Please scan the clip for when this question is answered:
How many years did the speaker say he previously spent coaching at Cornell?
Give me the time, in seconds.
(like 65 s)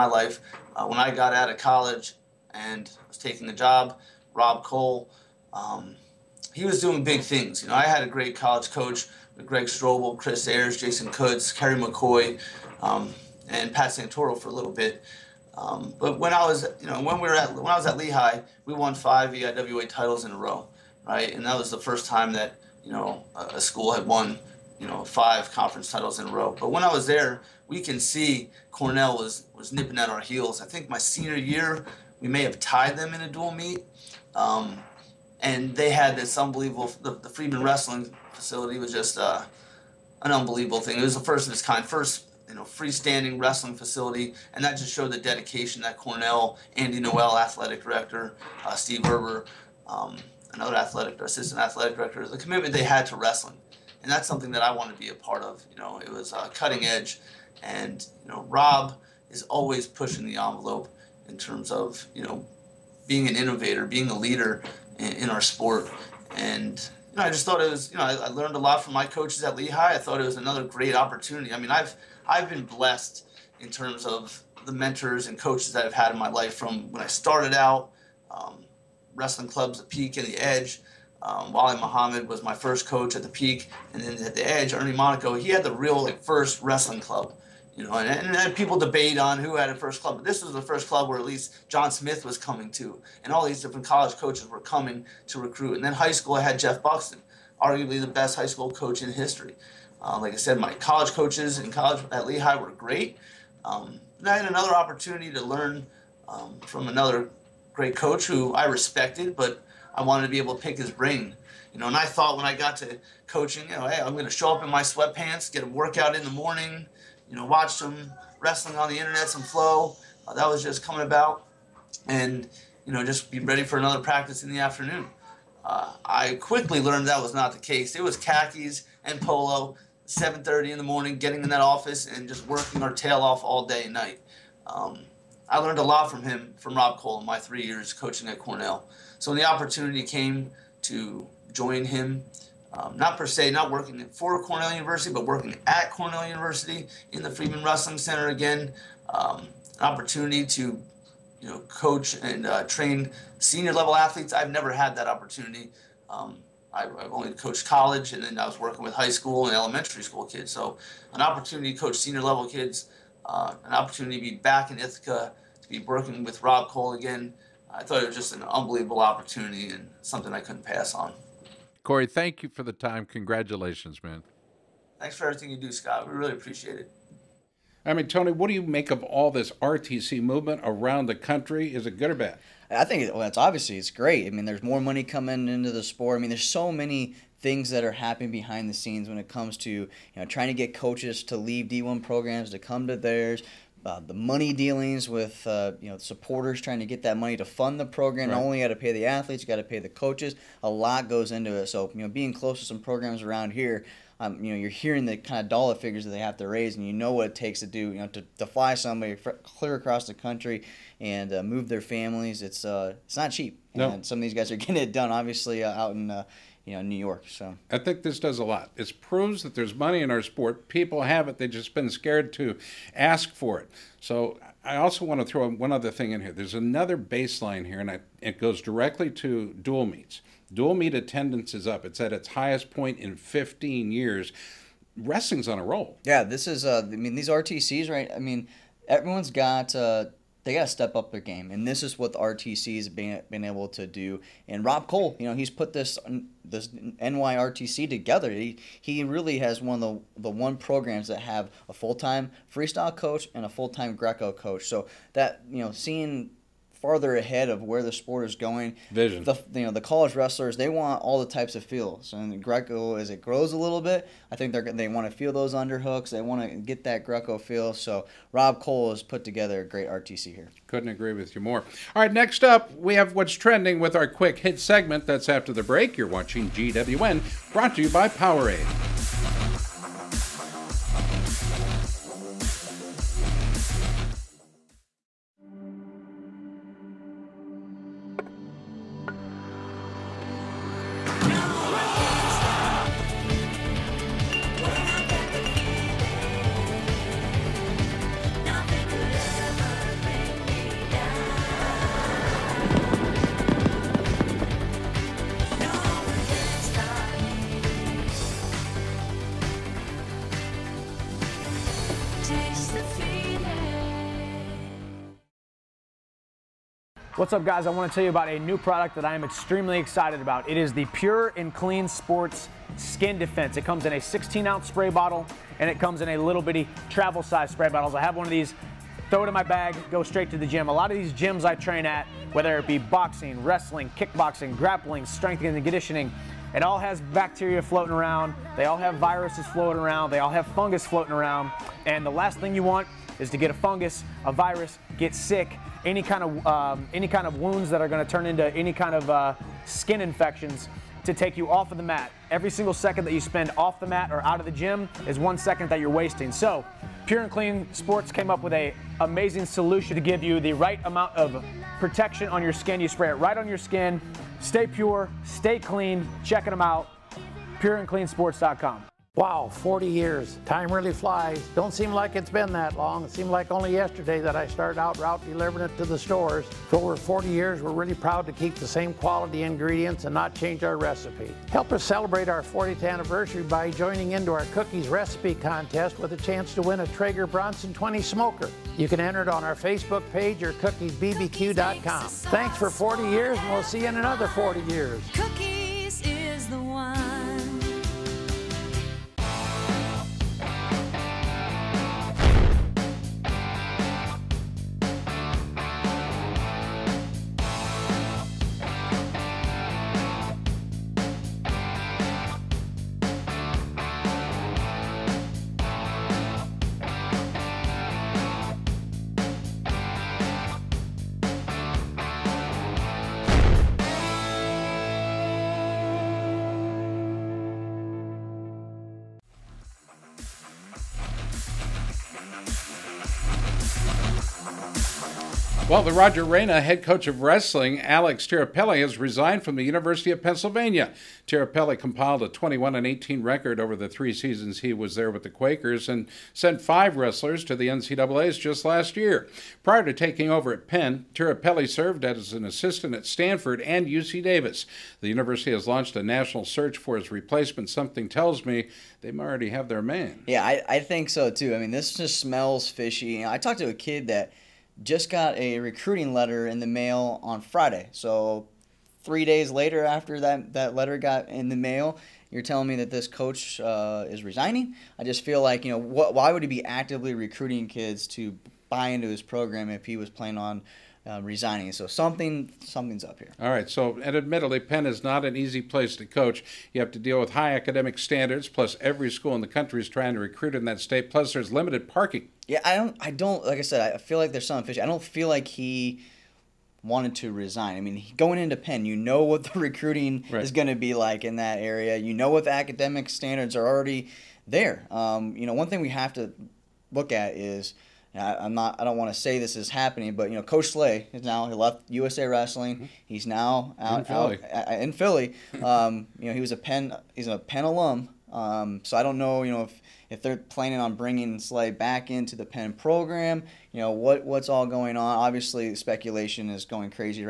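137 s.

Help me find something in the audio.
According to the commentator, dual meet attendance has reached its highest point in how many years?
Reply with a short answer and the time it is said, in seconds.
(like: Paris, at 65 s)
15, at 233 s.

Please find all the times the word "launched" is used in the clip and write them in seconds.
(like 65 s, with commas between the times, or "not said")
455 s.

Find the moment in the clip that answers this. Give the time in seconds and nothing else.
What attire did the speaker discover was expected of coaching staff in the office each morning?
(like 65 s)
128 s.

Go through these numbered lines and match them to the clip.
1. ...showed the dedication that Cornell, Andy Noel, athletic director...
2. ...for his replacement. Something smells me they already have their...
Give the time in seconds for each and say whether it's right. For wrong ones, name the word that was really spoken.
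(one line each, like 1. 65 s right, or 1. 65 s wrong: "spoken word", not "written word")
1. 44 s right
2. 456 s wrong: "tells", not "smells".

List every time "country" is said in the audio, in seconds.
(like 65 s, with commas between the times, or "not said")
181 s, 210 s, 489 s.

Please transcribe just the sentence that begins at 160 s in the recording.
So, an opportunity to coach senior level kids.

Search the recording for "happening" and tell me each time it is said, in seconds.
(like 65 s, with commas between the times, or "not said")
187 s, 509 s.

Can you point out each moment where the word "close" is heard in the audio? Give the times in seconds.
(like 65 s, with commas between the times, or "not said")
202 s.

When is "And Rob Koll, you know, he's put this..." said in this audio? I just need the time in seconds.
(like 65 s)
244 s.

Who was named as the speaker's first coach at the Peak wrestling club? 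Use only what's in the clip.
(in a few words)
Wally Muhammad.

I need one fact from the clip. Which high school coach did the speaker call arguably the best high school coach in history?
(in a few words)
Jeff Buxton.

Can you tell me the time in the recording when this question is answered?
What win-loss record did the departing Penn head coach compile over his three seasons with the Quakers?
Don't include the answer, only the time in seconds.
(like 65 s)
442 s.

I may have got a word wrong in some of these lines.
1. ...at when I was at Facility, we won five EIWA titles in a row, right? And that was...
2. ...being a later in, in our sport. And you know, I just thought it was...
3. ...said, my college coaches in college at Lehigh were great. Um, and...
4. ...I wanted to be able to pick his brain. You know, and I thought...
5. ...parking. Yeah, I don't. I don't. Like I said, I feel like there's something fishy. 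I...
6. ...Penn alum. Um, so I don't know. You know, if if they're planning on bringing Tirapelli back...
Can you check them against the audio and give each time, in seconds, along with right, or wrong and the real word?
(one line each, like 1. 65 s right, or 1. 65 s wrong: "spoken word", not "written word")
1. 17 s wrong: "Lehigh", not "Facility"
2. 63 s wrong: "leader", not "later"
3. 100 s right
4. 109 s right
5. 491 s right
6. 517 s wrong: "Slay", not "Tirapelli".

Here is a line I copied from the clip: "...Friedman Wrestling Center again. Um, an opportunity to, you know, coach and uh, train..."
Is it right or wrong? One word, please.
right.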